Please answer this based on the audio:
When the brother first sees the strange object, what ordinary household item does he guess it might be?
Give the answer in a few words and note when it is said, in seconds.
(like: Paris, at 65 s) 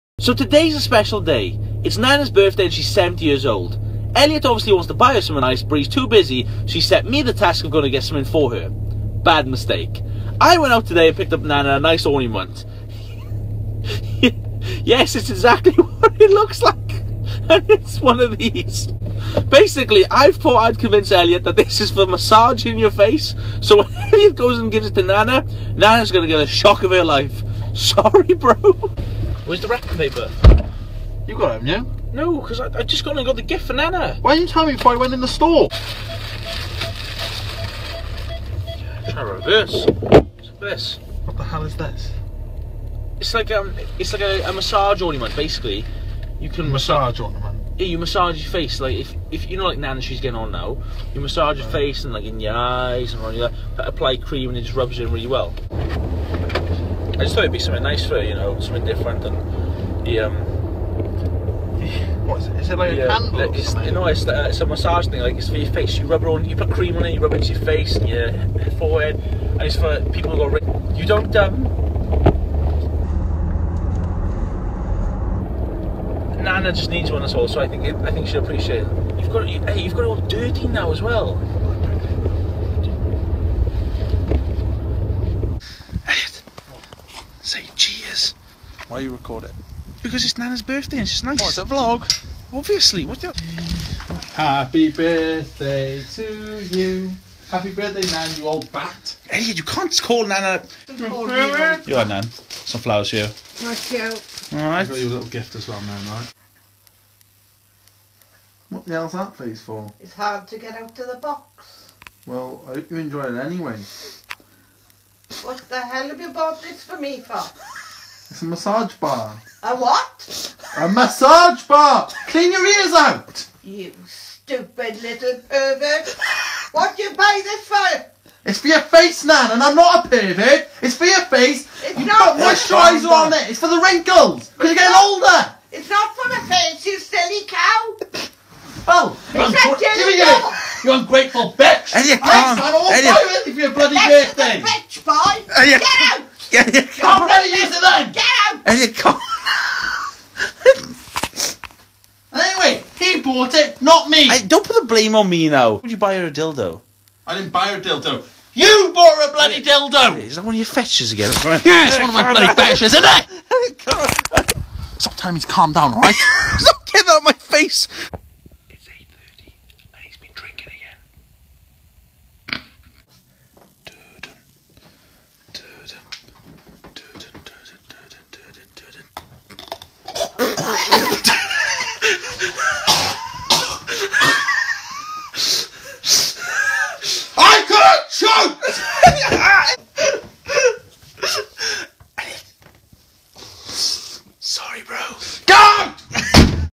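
candle, at 63 s.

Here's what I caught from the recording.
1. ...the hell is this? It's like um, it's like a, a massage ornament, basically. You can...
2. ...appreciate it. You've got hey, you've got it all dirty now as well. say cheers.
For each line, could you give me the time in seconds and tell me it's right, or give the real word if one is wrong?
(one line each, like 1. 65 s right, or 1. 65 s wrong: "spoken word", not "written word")
1. 41 s right
2. 78 s right.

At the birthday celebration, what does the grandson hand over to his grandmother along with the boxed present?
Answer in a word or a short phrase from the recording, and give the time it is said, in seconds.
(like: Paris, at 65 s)
flowers, at 102 s.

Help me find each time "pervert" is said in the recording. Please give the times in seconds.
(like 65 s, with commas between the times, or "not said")
125 s, 130 s.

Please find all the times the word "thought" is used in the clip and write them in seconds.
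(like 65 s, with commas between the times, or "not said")
20 s, 57 s.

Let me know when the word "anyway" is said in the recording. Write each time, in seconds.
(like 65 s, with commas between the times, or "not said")
113 s, 152 s.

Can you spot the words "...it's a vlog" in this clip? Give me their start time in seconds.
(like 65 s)
91 s.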